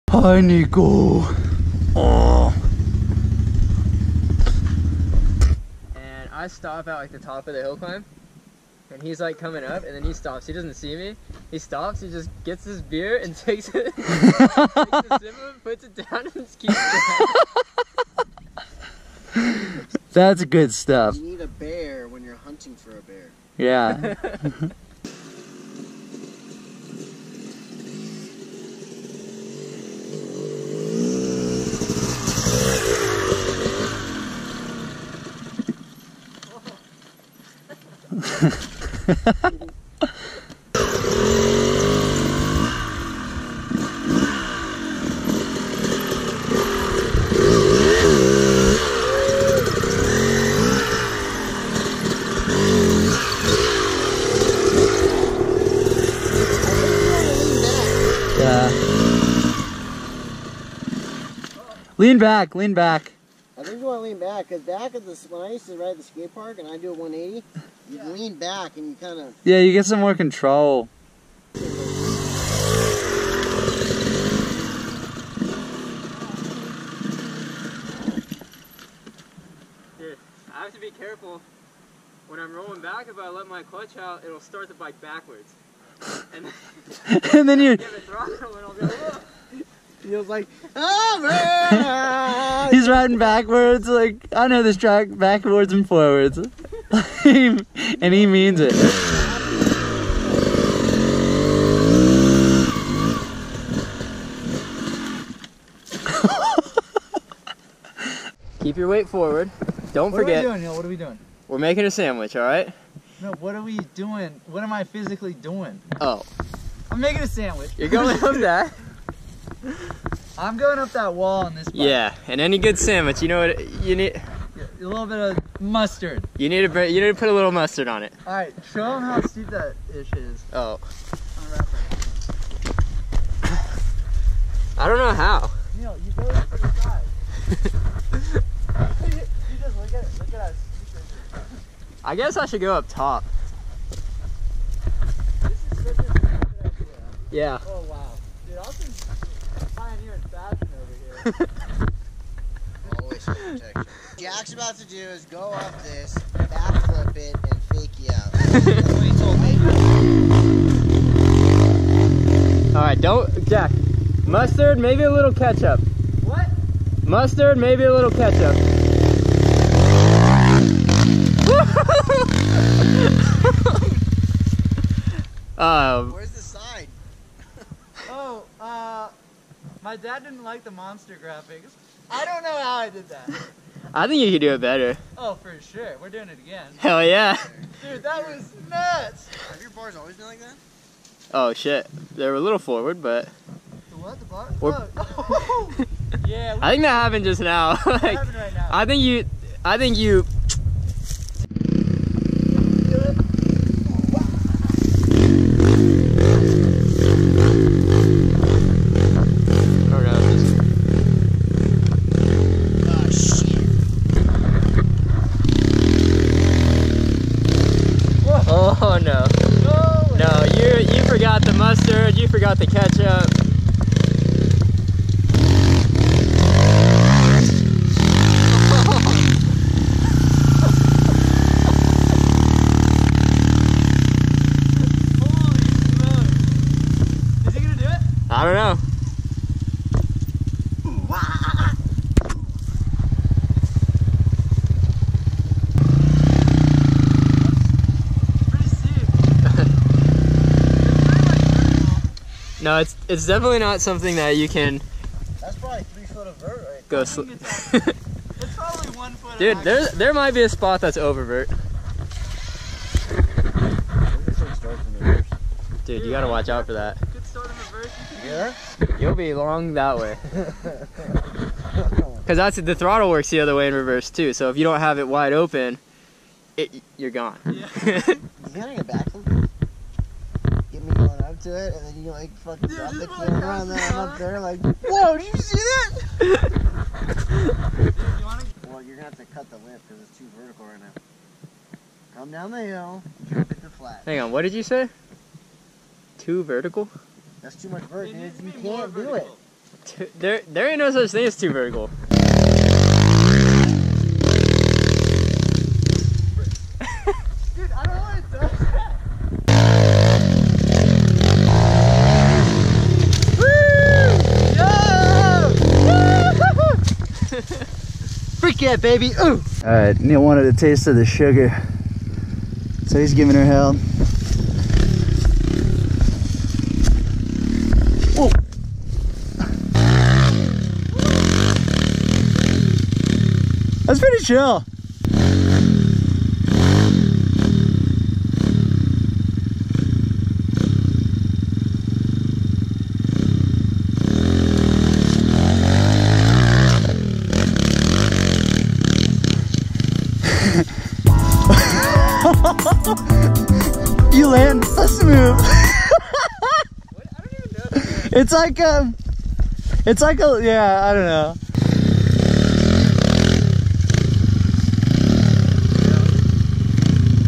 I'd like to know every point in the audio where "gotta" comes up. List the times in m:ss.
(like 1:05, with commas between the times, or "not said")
4:26, 4:38.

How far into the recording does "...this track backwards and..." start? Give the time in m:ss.
1:34.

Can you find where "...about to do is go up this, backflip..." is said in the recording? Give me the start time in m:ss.
2:34.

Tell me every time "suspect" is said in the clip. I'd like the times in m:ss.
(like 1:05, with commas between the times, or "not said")
not said.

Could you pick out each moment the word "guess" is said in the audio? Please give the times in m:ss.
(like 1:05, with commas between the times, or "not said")
2:22.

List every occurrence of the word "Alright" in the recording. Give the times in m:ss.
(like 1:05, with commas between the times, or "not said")
2:42.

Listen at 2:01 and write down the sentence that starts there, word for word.
Yeah, and any good sandwich, you know what you need a little bit of mustard.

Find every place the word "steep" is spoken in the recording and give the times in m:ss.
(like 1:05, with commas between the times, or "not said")
2:09.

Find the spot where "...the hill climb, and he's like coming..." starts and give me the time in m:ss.
0:07.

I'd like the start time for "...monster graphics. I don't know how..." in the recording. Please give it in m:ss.
3:00.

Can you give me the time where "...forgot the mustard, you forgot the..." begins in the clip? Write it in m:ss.
3:41.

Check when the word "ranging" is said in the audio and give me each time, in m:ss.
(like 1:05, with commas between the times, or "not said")
not said.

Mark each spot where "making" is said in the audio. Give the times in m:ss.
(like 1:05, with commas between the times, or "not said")
1:51, 1:56.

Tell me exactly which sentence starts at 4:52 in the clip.
Come down the hill, drop it to flat.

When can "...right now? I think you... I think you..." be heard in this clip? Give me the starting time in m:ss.
3:18.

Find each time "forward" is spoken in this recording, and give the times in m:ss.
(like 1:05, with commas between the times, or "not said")
1:35, 1:49, 3:12.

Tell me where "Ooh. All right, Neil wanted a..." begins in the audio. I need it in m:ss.
5:19.